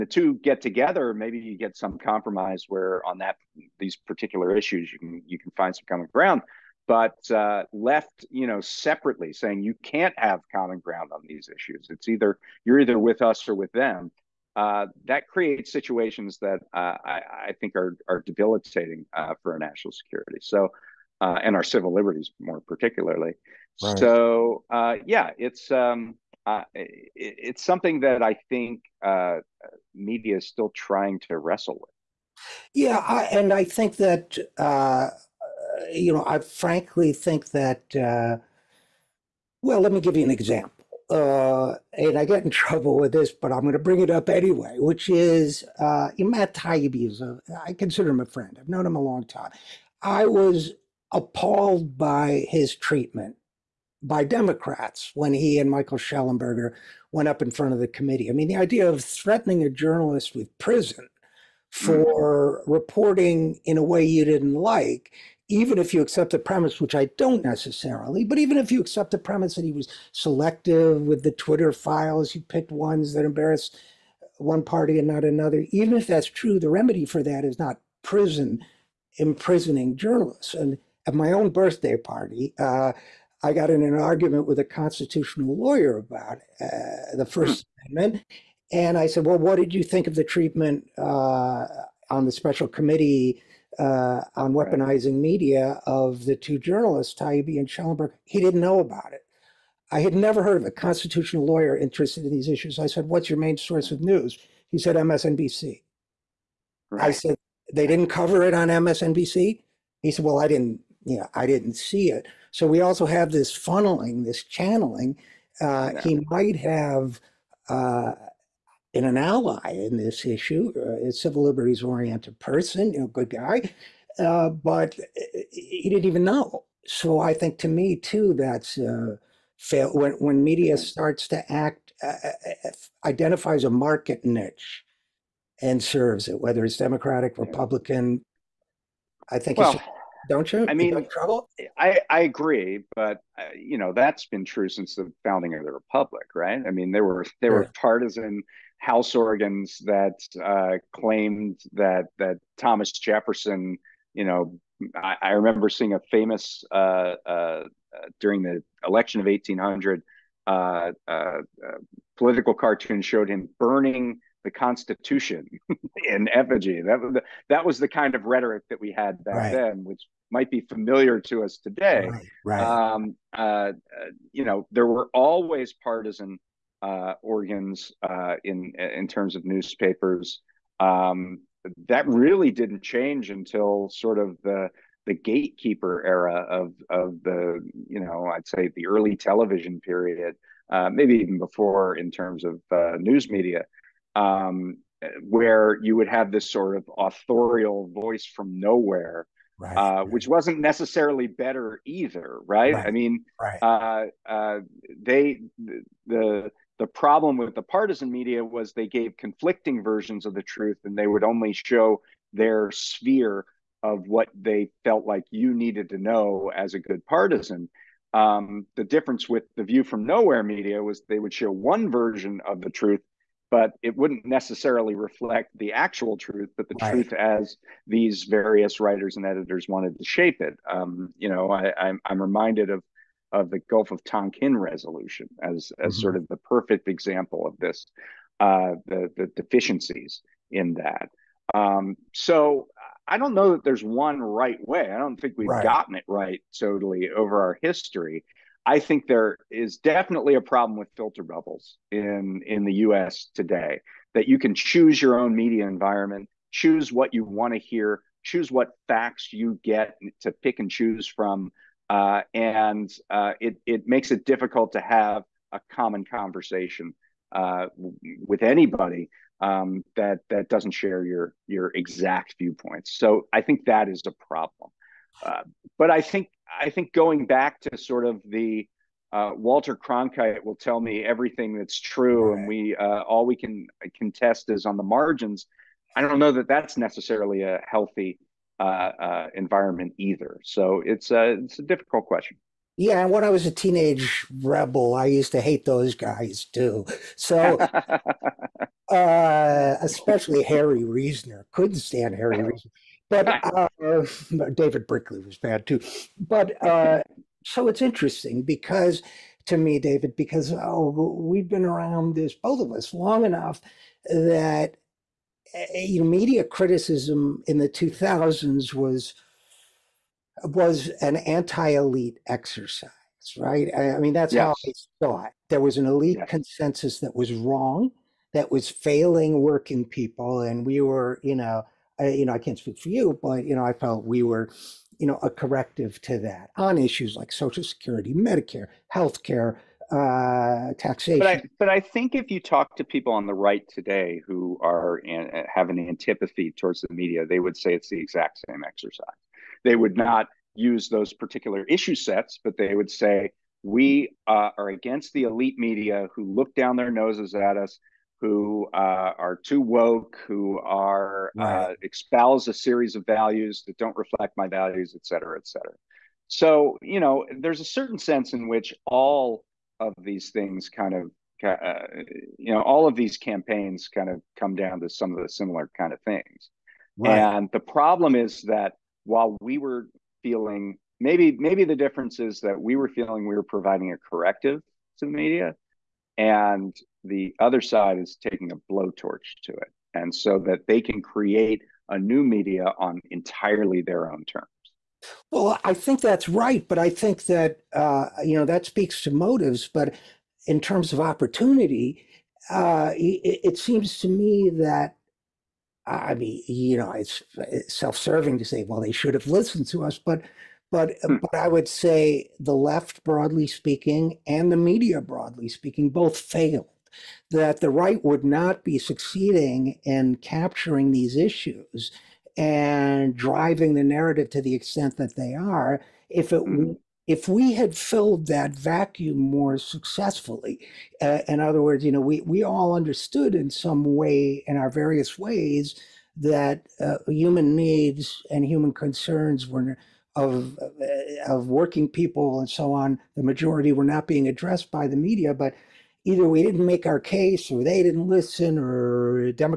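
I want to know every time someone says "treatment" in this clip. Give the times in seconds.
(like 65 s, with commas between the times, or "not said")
52 s, 90 s.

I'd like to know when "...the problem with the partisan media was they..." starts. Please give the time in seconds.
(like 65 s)
206 s.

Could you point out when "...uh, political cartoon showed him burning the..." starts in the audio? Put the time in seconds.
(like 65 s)
161 s.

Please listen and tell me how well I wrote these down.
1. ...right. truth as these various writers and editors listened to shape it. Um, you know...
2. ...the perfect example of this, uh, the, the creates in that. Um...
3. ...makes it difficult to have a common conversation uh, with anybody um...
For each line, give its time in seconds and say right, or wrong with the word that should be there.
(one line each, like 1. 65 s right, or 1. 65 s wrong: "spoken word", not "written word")
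1. 226 s wrong: "wanted", not "listened"
2. 236 s wrong: "deficiencies", not "creates"
3. 263 s right.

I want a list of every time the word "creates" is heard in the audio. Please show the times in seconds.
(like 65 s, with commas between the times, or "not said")
15 s, 391 s.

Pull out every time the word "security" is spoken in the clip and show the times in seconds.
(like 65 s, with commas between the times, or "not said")
19 s, 337 s.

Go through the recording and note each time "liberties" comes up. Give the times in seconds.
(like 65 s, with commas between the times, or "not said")
21 s, 121 s.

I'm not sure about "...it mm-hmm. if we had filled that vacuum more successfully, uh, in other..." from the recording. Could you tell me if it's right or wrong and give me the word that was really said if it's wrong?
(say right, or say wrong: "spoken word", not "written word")
right.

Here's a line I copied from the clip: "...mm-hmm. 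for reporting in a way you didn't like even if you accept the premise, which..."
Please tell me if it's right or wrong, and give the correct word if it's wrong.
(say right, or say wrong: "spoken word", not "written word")
right.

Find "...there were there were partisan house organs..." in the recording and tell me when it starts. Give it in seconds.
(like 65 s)
146 s.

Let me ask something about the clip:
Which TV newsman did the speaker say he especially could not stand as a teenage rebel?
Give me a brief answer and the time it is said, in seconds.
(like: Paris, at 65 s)
Harry Reasoner, at 300 s.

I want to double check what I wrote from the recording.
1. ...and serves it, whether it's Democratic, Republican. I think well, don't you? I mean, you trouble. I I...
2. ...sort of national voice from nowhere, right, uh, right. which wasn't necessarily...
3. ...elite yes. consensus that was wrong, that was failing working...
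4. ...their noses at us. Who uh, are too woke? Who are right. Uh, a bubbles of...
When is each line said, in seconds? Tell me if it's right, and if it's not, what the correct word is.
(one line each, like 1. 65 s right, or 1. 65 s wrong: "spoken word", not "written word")
1. 135 s right
2. 196 s wrong: "authorial", not "national"
3. 325 s right
4. 356 s wrong: "series", not "bubbles".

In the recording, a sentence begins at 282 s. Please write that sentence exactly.
and we uh, all we can contest is on the margins.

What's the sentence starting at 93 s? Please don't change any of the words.
uh, on weaponizing media of the two journalists, Taibbi and Schellenberg.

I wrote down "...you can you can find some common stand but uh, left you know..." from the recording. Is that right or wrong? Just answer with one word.
wrong.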